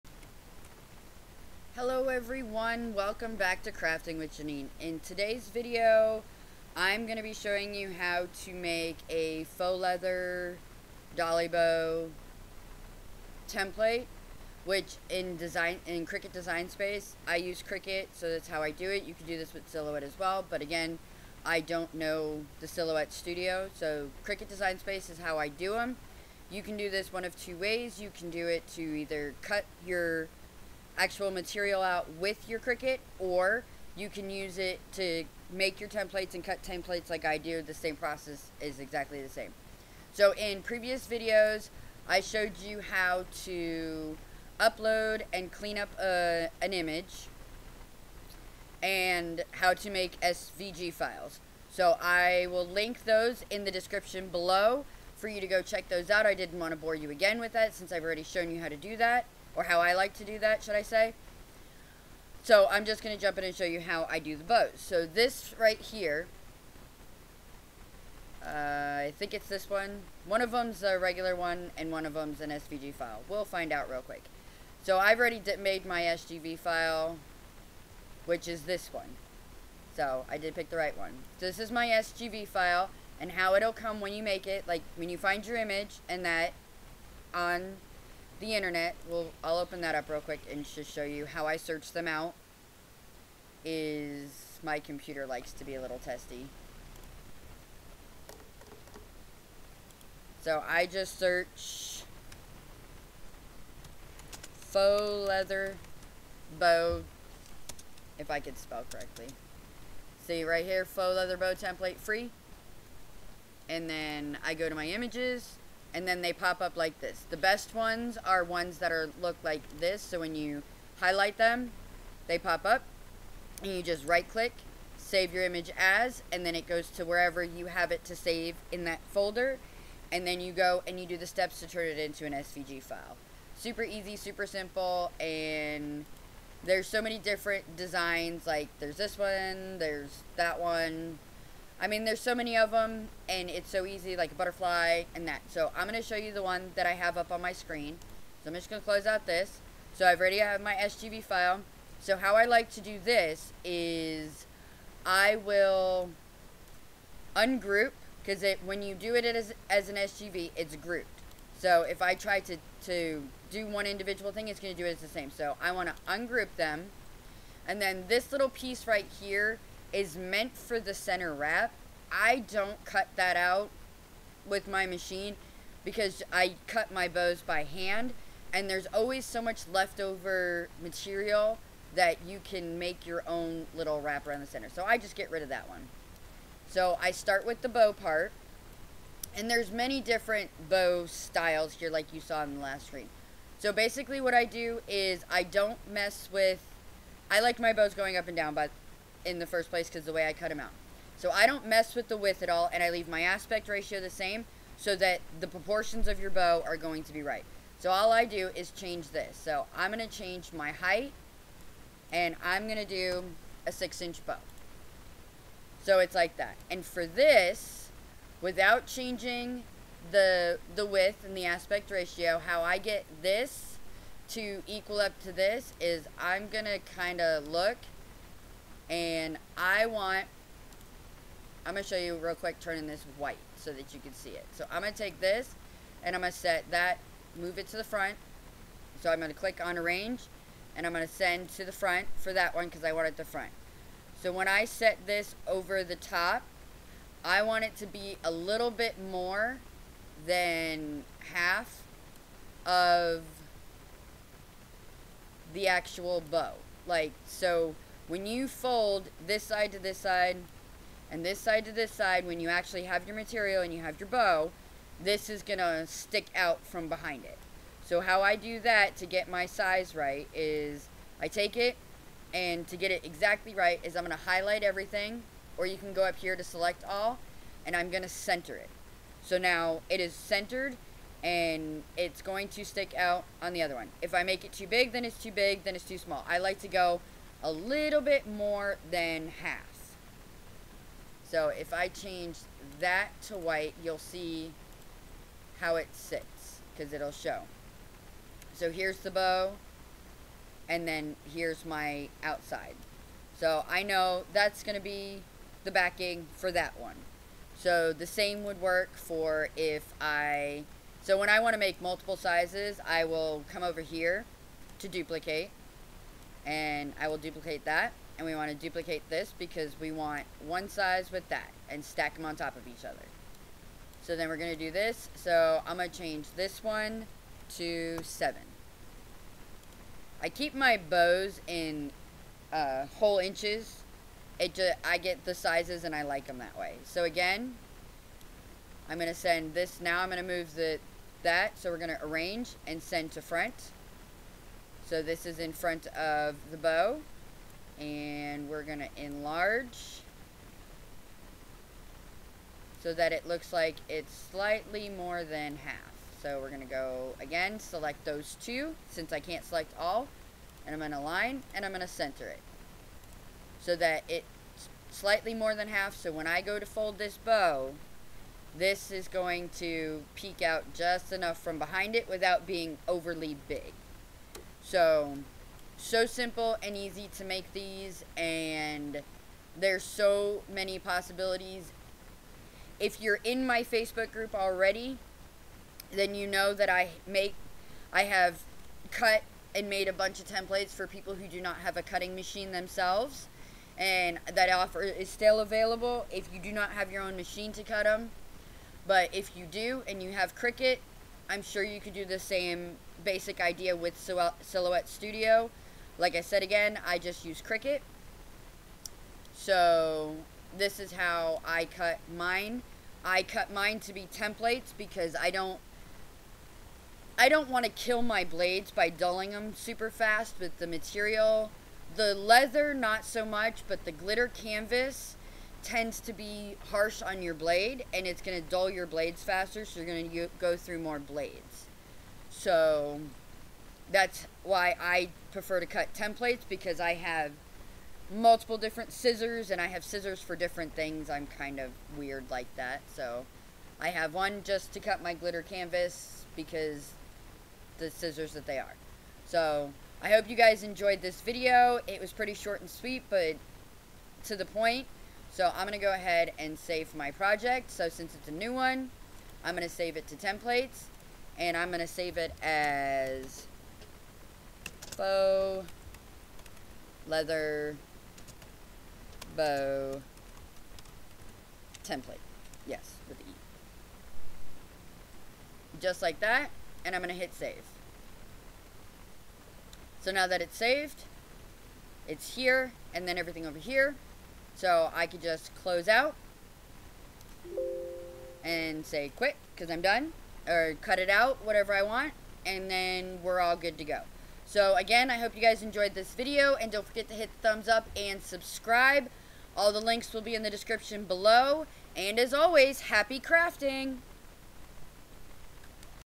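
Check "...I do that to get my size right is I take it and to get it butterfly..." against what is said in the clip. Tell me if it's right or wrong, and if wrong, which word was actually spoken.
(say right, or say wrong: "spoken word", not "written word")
wrong: "exactly", not "butterfly".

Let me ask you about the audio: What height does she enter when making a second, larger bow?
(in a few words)
7.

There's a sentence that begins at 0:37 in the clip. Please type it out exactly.
The same process is exactly the same.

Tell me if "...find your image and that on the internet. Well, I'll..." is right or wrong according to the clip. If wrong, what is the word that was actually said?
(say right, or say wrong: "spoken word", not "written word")
right.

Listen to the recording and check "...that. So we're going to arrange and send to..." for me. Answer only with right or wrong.
right.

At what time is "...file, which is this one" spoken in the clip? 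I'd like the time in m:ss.
1:16.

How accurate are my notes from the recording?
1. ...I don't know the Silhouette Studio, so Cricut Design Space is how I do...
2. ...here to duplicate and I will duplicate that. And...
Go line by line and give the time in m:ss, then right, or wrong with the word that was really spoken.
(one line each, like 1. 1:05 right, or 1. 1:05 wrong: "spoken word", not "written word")
1. 0:21 right
2. 5:13 right.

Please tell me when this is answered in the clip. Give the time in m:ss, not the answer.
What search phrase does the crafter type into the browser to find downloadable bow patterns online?
1:50.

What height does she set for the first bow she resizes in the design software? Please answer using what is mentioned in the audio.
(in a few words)
6 inches.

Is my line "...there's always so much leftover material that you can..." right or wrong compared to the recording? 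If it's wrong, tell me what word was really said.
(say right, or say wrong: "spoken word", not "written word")
right.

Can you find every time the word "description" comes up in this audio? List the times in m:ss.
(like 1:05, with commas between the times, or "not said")
0:53, 8:20.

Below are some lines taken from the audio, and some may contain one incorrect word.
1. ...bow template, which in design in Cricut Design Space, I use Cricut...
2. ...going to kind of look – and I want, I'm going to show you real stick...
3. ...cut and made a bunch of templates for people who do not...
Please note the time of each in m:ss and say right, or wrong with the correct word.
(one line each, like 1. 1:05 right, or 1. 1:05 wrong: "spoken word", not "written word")
1. 0:11 right
2. 3:46 wrong: "quick", not "stick"
3. 6:28 right.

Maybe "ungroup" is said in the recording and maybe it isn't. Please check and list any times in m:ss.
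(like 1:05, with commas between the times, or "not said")
2:37, 2:46.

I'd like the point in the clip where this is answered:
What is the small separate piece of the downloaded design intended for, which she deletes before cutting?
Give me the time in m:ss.
2:50.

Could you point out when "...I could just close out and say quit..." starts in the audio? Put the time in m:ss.
8:04.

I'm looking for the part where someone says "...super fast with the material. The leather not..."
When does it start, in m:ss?
6:59.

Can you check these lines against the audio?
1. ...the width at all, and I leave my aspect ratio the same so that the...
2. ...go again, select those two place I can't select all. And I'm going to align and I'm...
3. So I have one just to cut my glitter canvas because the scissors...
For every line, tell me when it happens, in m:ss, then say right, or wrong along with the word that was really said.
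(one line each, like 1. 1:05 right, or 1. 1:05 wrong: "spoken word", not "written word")
1. 3:22 right
2. 5:56 wrong: "since", not "place"
3. 7:22 right.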